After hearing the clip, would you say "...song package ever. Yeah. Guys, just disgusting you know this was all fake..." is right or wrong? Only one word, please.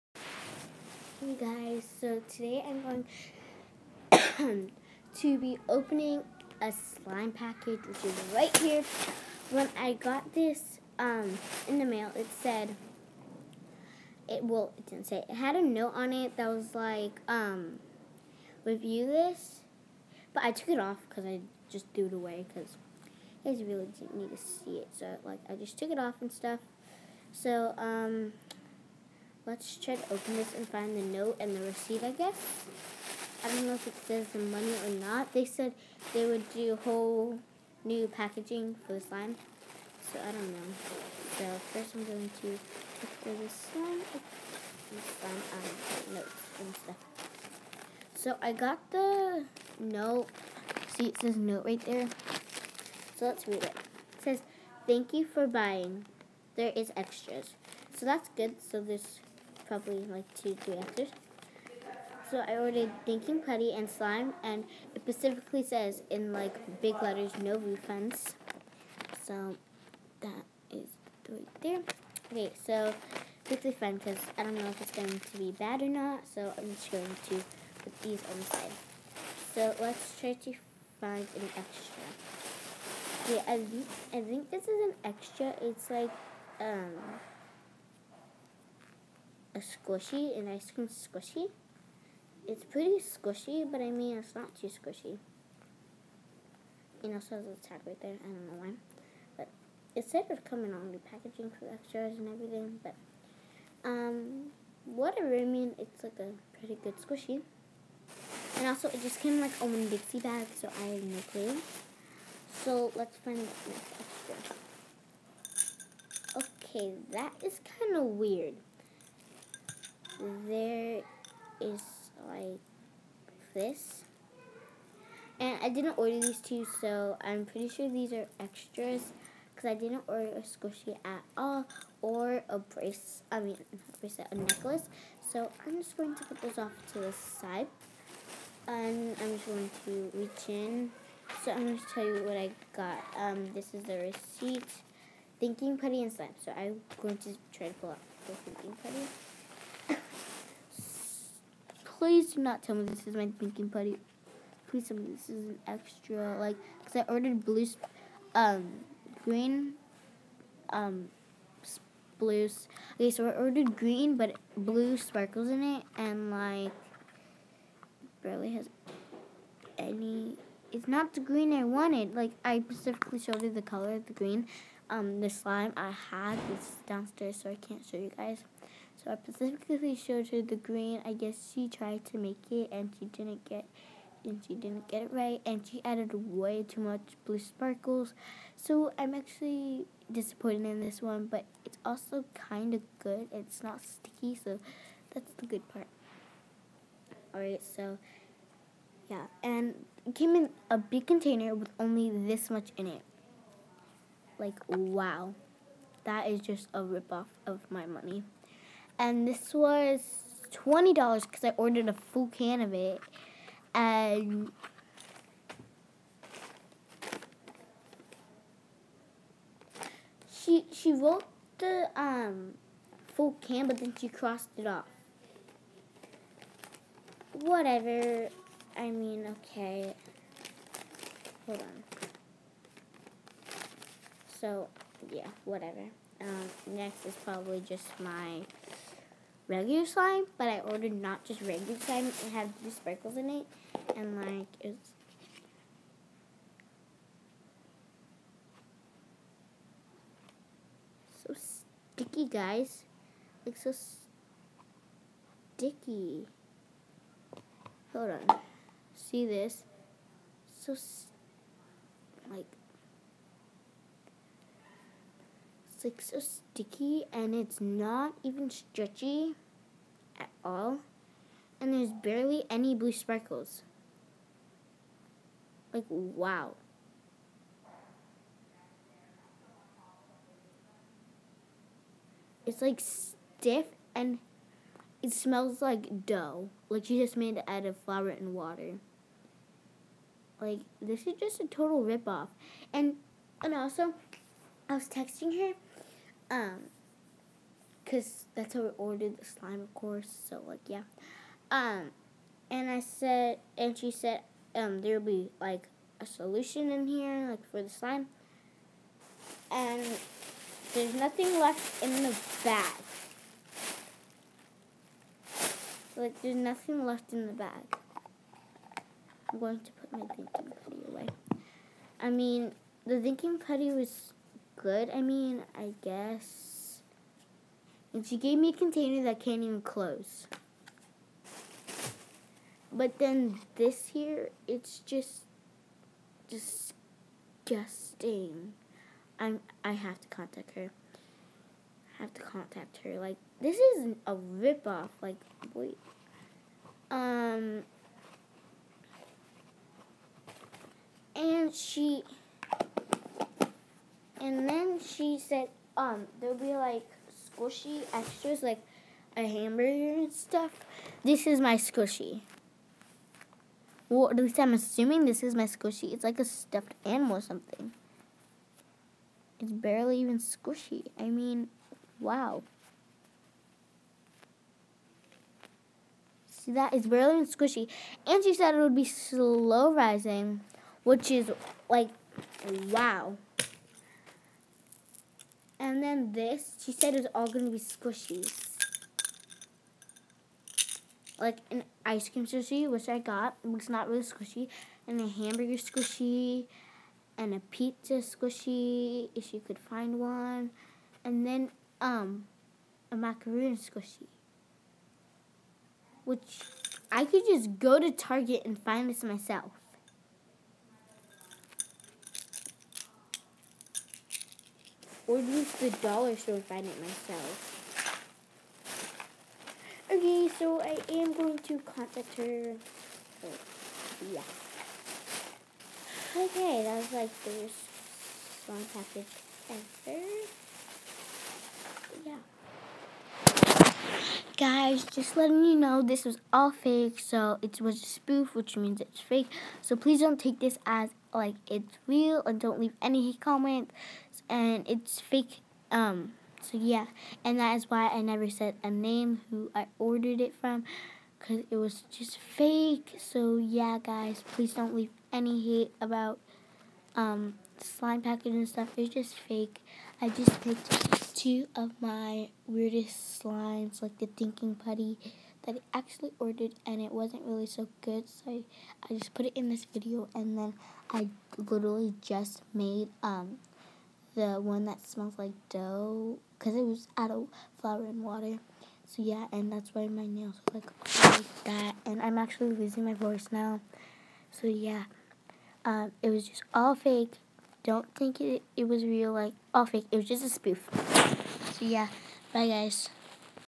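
wrong.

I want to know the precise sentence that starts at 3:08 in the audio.
So I'm actually disappointed in this one, but it's also kind of good.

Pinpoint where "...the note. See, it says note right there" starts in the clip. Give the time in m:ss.
0:48.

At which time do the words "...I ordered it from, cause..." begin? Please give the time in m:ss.
7:29.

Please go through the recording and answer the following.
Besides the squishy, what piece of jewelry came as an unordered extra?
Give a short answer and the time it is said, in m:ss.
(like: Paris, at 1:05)
A necklace, at 2:14.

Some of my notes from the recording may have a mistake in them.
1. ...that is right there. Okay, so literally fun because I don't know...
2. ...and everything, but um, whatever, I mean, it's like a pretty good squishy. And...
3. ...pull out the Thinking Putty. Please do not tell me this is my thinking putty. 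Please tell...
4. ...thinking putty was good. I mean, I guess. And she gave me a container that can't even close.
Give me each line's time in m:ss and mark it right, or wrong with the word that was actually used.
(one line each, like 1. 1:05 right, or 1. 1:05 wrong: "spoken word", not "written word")
1. 1:10 wrong: "quickly", not "literally"
2. 1:42 right
3. 2:27 right
4. 5:23 right.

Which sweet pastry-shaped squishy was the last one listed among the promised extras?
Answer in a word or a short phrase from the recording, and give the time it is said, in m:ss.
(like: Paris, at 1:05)
Macaroon, at 6:42.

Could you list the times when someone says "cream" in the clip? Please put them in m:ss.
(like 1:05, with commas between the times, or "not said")
1:30, 6:32.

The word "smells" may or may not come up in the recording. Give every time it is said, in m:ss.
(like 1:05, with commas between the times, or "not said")
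4:45, 7:54.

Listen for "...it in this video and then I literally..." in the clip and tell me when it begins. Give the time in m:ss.
7:49.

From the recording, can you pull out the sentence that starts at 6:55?
or use the dollar store to find it myself.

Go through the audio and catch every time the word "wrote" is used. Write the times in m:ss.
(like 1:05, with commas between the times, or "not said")
3:40.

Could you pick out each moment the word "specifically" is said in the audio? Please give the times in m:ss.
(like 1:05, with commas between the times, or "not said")
1:05, 2:52, 2:59.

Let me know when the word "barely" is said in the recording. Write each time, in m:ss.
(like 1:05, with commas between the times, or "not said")
2:48, 4:31, 6:09, 6:16.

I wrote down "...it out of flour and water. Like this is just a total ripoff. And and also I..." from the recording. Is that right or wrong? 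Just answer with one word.
right.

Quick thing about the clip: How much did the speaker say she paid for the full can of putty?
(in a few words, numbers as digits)
20 dollars.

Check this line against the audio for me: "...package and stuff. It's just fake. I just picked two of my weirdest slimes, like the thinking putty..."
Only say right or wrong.
right.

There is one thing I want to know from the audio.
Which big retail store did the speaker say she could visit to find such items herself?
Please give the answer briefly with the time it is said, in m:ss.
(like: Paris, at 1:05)
Target, at 6:47.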